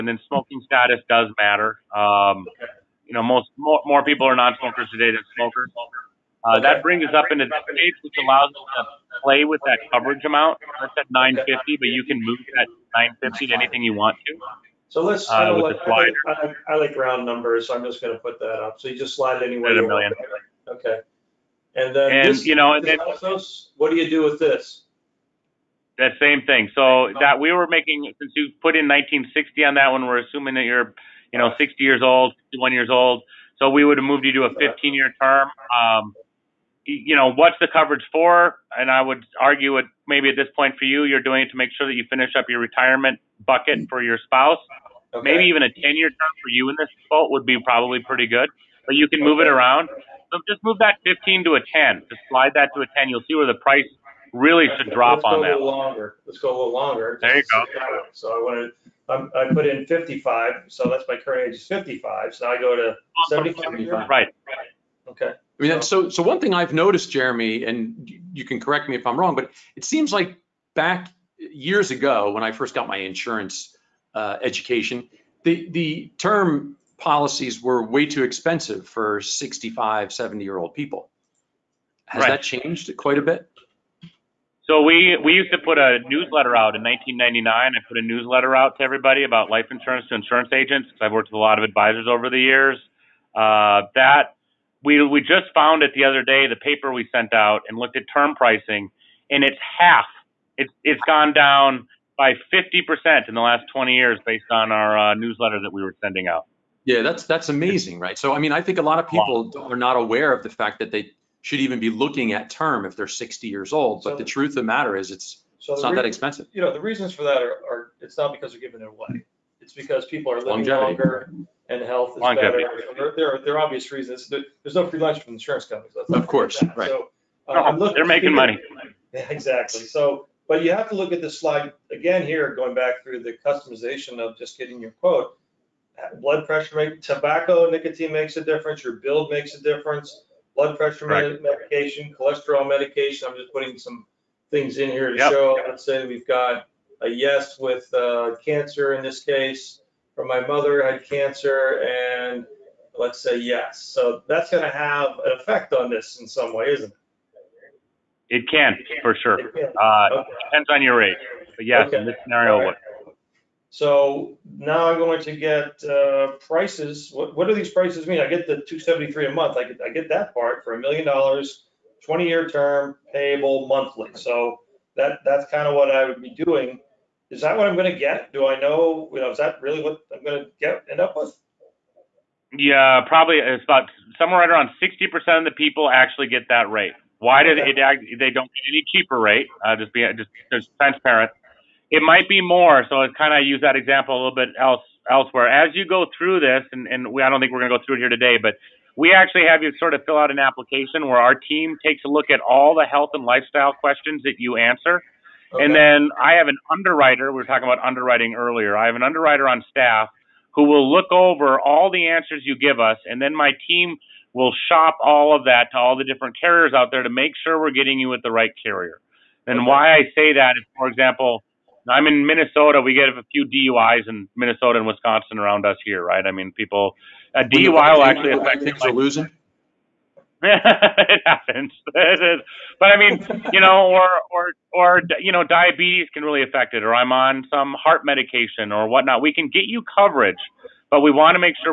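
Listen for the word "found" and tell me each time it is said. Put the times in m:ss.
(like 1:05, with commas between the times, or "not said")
1:35.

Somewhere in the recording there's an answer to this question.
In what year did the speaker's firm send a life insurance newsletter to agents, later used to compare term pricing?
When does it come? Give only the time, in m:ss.
1:26.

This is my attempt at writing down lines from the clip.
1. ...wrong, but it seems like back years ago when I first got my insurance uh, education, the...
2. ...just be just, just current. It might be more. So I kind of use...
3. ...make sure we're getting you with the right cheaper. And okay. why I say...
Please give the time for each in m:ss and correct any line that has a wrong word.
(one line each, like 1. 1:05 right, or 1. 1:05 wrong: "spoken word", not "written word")
1. 1:09 right
2. 3:09 wrong: "transparent", not "current"
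3. 3:37 wrong: "carrier", not "cheaper".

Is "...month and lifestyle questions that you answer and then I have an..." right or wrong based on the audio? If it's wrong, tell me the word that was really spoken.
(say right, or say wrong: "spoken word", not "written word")
wrong: "health", not "month".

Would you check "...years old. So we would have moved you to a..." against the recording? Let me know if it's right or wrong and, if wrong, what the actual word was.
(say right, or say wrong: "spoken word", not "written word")
right.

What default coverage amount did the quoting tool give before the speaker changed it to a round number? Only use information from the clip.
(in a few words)
950.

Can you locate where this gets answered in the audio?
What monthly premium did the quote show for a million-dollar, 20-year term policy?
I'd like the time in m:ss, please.
2:48.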